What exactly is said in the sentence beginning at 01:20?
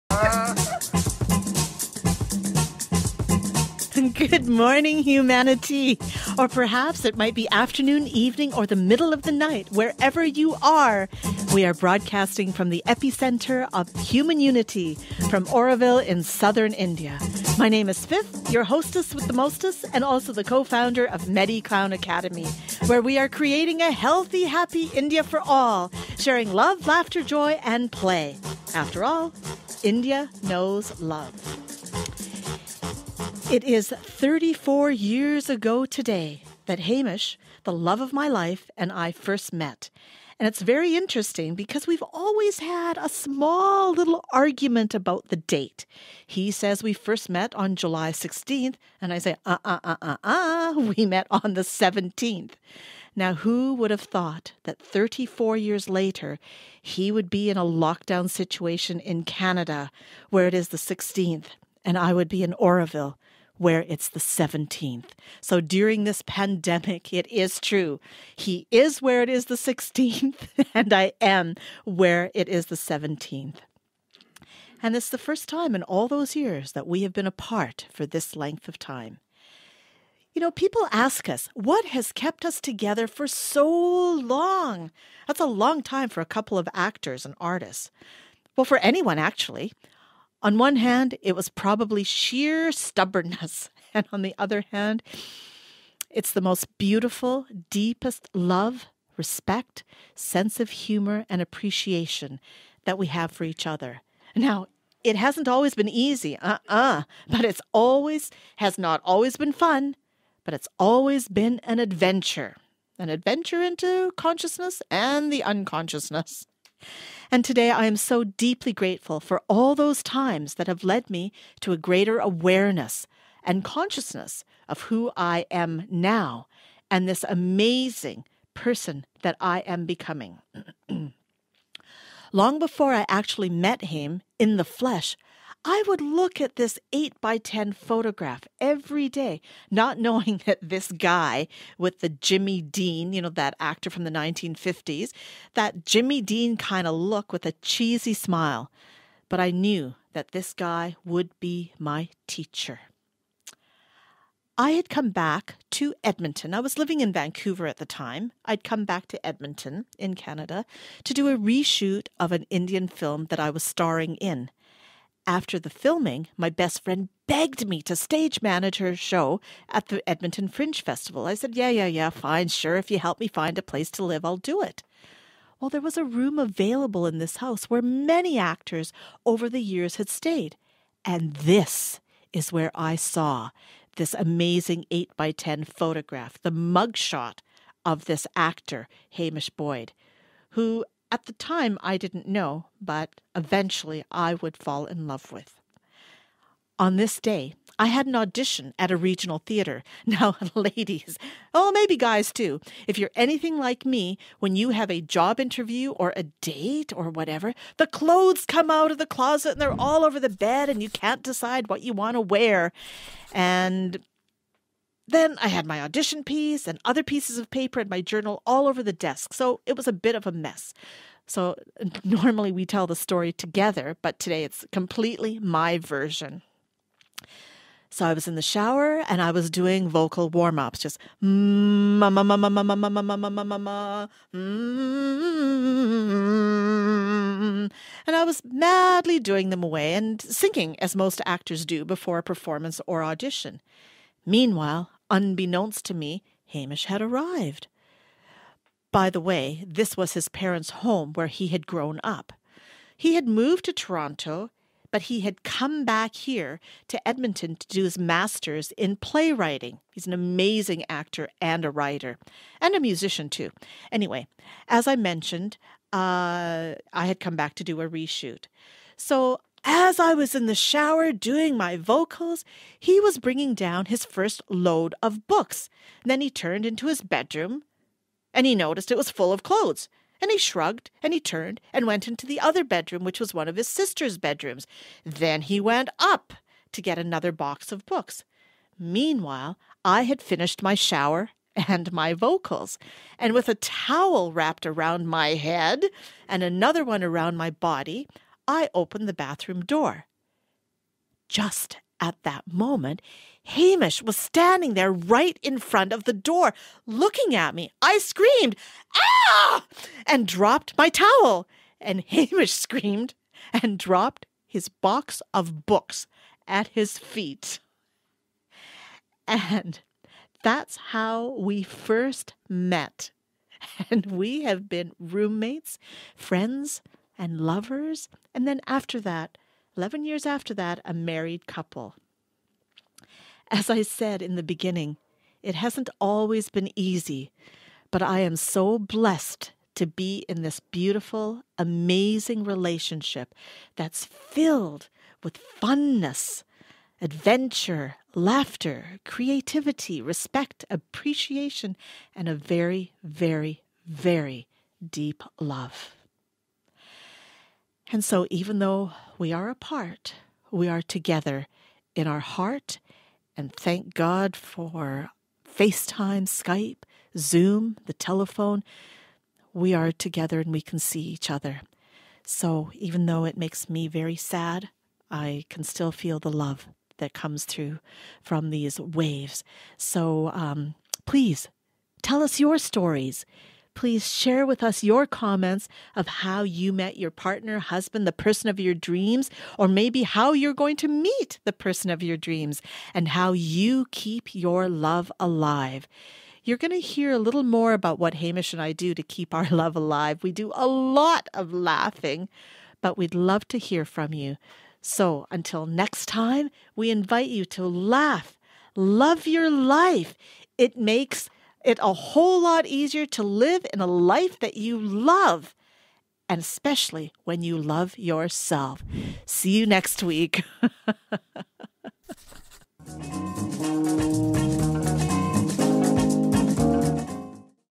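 You know, people ask us, what has kept us together for so long?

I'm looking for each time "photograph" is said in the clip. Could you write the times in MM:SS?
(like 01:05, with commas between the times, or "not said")
02:17, 03:05.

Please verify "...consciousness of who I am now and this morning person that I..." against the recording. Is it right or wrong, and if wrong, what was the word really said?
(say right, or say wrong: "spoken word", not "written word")
wrong: "amazing", not "morning".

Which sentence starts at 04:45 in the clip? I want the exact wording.
Then he went up to get another box of books.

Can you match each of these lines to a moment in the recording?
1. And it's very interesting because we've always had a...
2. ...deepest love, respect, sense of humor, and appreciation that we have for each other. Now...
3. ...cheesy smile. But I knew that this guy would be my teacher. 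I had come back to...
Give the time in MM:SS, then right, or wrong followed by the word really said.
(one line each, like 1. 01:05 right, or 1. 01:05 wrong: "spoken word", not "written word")
1. 00:40 right
2. 01:37 right
3. 02:27 right.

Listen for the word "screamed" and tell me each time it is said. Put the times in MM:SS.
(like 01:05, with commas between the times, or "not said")
05:07, 05:12.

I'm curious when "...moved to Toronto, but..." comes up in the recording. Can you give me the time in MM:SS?
04:13.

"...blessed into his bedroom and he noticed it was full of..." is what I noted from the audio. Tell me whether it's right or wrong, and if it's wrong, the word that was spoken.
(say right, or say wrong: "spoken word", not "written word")
wrong: "turned", not "blessed".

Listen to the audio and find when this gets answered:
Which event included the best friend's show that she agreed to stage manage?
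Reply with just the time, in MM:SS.
02:50.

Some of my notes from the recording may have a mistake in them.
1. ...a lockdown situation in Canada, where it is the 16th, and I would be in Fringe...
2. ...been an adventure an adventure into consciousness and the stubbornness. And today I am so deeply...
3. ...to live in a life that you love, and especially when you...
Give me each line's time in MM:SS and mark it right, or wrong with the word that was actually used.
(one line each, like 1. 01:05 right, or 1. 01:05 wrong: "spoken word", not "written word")
1. 00:57 wrong: "Auroville", not "Fringe"
2. 01:51 wrong: "unconsciousness", not "stubbornness"
3. 06:53 right.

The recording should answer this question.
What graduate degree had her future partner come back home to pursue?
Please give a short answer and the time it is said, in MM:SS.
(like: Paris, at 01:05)
Master's in playwriting, at 04:17.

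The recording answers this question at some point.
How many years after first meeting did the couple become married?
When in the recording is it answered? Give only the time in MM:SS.
05:29.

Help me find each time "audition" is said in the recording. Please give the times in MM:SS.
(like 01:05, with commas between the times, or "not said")
03:18, 03:35, 04:03.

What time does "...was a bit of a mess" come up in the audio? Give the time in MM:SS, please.
03:39.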